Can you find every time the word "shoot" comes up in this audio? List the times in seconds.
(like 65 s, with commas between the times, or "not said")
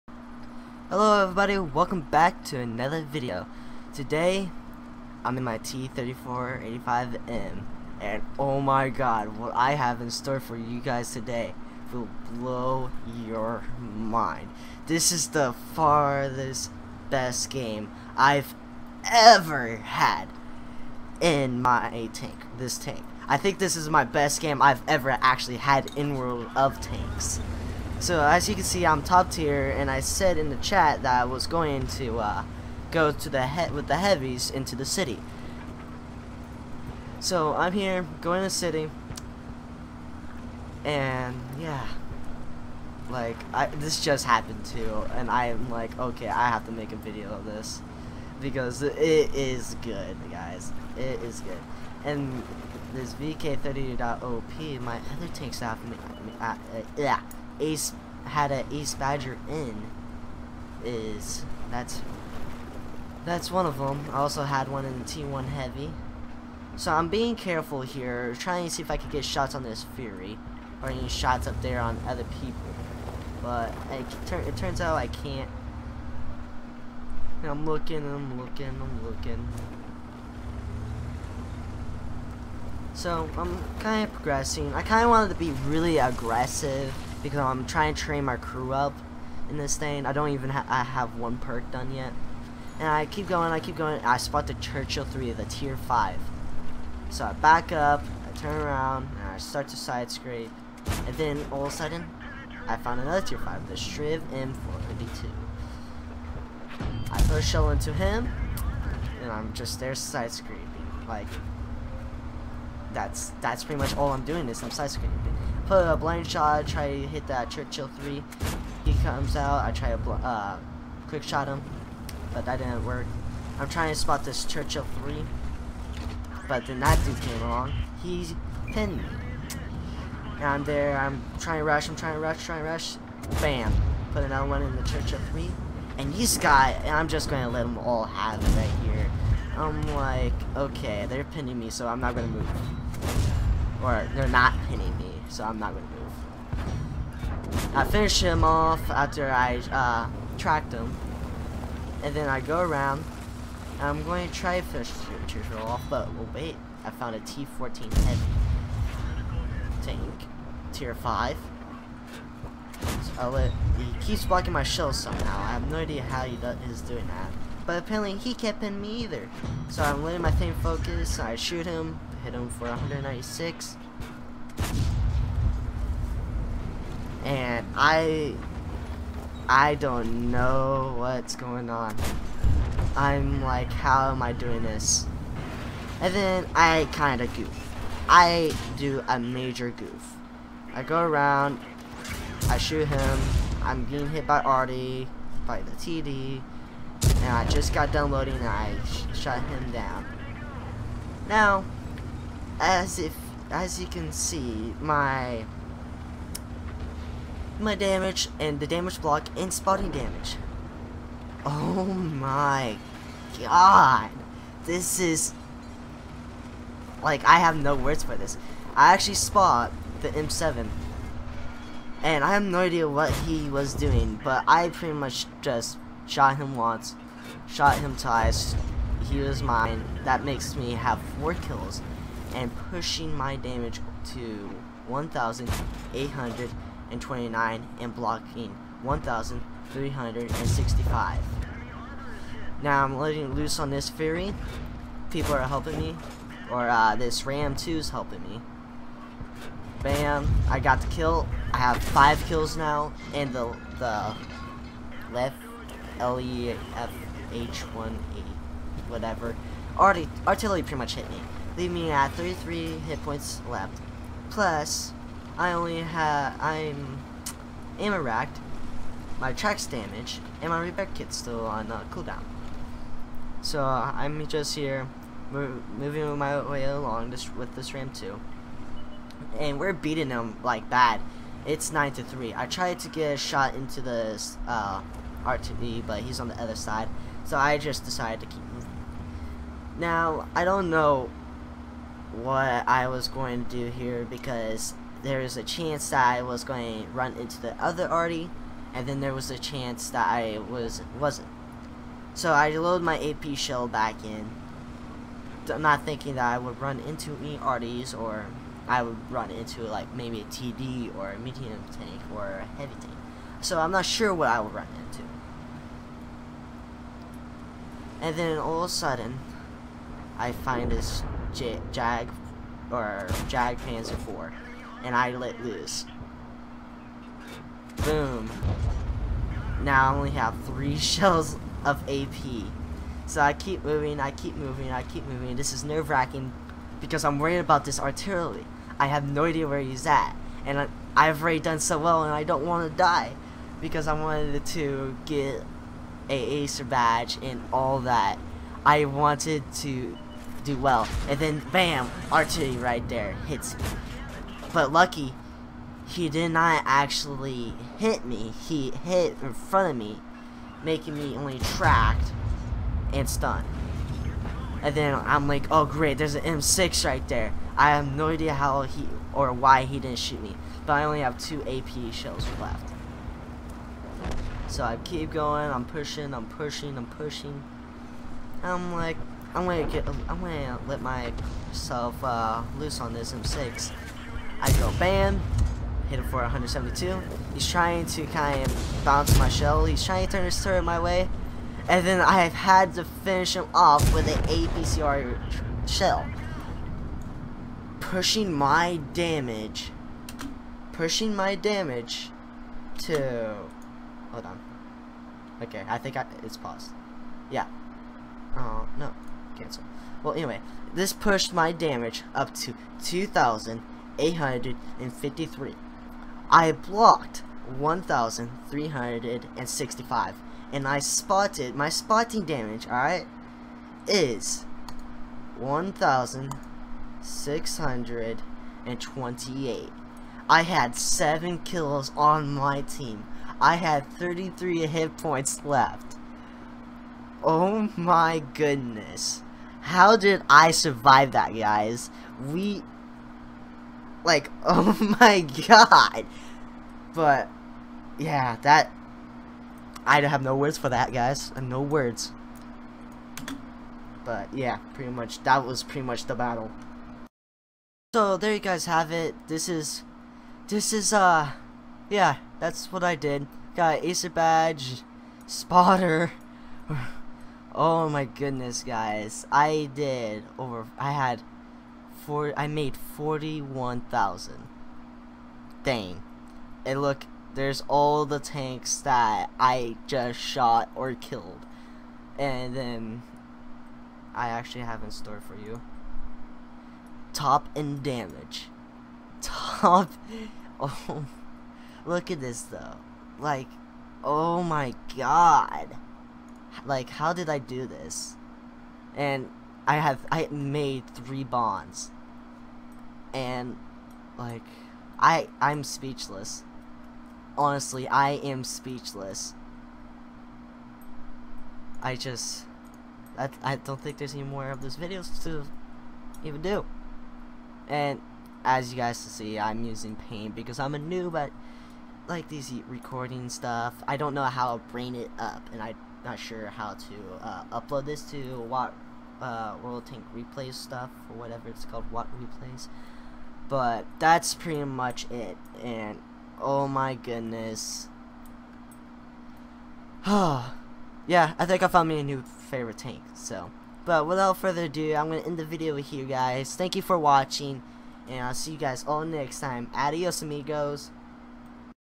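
171 s, 192 s, 369 s.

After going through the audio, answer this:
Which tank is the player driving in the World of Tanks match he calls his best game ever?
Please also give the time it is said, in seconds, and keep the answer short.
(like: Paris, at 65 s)
T3485M, at 5 s.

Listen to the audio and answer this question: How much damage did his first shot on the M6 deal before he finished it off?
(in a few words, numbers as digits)
172.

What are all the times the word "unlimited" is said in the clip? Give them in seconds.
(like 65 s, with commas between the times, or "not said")
not said.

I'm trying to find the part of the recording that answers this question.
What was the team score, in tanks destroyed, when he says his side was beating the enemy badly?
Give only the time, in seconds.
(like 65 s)
281 s.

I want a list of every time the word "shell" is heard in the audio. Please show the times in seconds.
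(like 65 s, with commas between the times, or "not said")
107 s, 164 s, 303 s, 330 s, 371 s, 389 s, 395 s.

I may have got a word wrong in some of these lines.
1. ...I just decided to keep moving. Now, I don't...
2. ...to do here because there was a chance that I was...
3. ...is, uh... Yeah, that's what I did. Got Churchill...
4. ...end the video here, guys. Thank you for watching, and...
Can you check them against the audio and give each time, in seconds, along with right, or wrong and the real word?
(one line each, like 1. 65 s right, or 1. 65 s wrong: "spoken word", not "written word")
1. 287 s right
2. 293 s right
3. 460 s wrong: "Acer", not "Churchill"
4. 545 s right.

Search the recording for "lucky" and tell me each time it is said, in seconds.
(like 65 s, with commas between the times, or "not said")
354 s.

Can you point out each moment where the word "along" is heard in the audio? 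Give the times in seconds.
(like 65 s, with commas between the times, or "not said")
127 s, 276 s.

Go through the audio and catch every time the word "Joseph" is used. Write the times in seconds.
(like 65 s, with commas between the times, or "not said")
not said.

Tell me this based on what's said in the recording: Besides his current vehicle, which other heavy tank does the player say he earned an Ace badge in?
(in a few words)
T1 Heavy.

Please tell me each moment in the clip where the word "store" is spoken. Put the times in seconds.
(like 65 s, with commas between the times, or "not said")
10 s, 484 s.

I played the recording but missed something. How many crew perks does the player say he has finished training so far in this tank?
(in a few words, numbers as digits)
1.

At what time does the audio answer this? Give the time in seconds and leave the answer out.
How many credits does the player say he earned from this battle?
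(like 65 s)
472 s.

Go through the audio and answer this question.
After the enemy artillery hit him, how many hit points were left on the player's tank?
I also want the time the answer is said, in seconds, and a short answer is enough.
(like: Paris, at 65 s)
33, at 262 s.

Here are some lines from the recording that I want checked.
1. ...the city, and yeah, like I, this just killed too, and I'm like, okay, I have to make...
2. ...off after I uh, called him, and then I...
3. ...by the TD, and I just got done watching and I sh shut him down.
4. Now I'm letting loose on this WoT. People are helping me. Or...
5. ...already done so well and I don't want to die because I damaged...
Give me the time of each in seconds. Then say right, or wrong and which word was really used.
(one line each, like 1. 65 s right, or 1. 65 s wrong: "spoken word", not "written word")
1. 38 s wrong: "happened", not "killed"
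2. 148 s wrong: "tracked", not "called"
3. 195 s wrong: "loading", not "watching"
4. 242 s wrong: "Fury", not "WoT"
5. 341 s wrong: "wanted", not "damaged".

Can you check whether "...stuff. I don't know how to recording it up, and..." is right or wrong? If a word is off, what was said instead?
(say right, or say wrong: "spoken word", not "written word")
wrong: "bring", not "recording".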